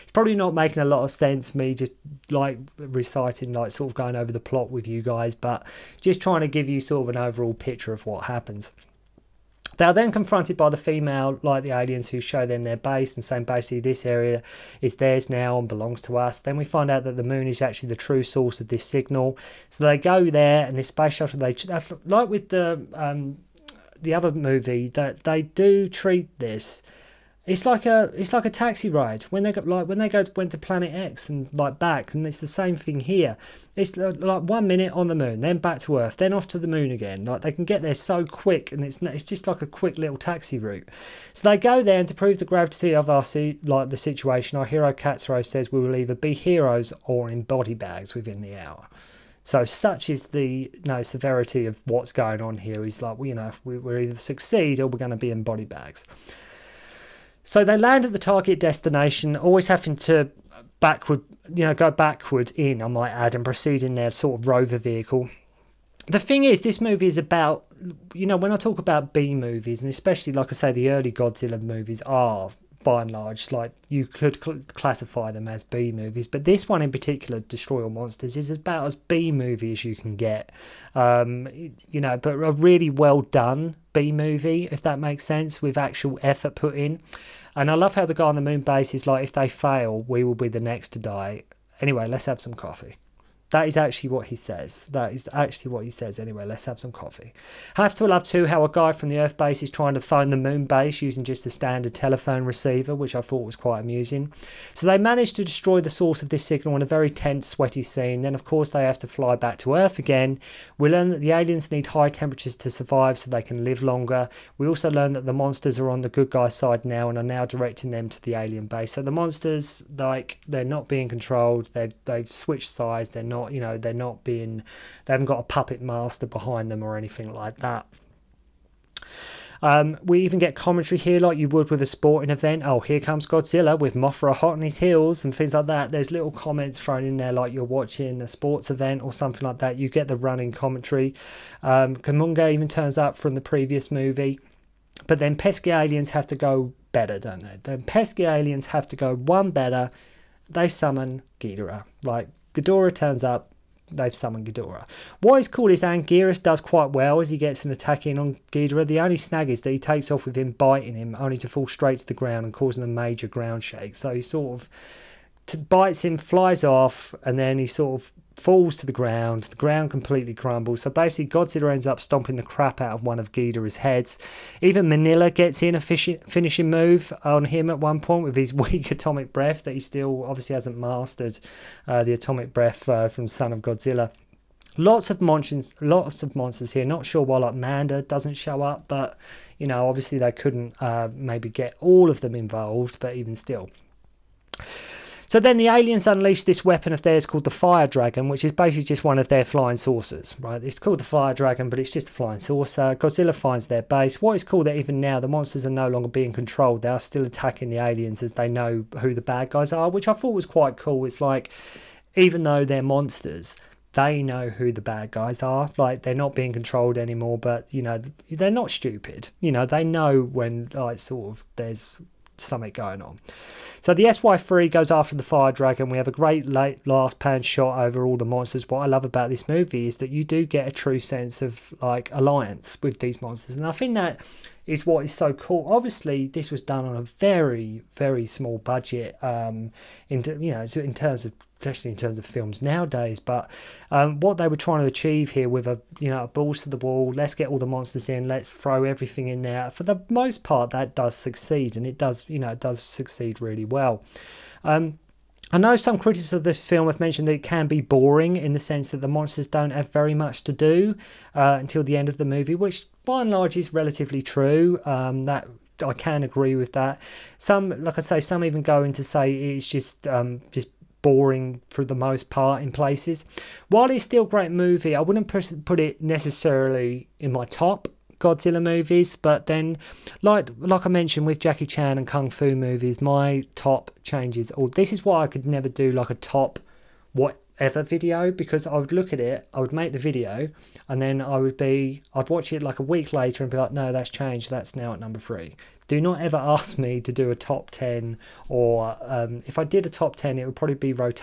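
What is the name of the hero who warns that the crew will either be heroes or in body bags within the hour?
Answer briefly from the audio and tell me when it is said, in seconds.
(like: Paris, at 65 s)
Katsuo, at 44 s.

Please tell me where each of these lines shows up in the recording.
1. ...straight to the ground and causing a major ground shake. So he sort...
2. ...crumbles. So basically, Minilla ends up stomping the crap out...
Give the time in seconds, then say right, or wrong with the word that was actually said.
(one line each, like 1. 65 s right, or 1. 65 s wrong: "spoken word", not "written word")
1. 161 s right
2. 170 s wrong: "Godzilla", not "Minilla".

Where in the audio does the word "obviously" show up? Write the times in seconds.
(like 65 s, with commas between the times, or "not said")
180 s, 189 s, 235 s.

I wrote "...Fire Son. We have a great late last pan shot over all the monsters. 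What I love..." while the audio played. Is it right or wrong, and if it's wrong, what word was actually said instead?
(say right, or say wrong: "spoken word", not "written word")
wrong: "Dragon", not "Son".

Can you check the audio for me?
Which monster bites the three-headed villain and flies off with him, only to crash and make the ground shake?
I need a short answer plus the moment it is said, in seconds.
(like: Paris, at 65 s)
Anguirus, at 155 s.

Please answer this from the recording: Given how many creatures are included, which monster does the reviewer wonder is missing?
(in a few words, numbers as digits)
Manda.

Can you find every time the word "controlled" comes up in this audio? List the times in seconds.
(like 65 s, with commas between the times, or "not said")
121 s, 206 s, 216 s.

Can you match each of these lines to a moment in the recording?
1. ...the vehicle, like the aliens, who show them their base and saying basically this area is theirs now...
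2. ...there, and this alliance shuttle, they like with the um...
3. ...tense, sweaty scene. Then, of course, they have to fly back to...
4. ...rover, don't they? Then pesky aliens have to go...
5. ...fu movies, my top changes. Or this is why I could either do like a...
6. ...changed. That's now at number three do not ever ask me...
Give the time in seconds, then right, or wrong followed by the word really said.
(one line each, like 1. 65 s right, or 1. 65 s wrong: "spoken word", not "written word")
1. 10 s wrong: "female", not "vehicle"
2. 20 s wrong: "space", not "alliance"
3. 107 s right
4. 146 s wrong: "better", not "rover"
5. 282 s wrong: "never", not "either"
6. 294 s right.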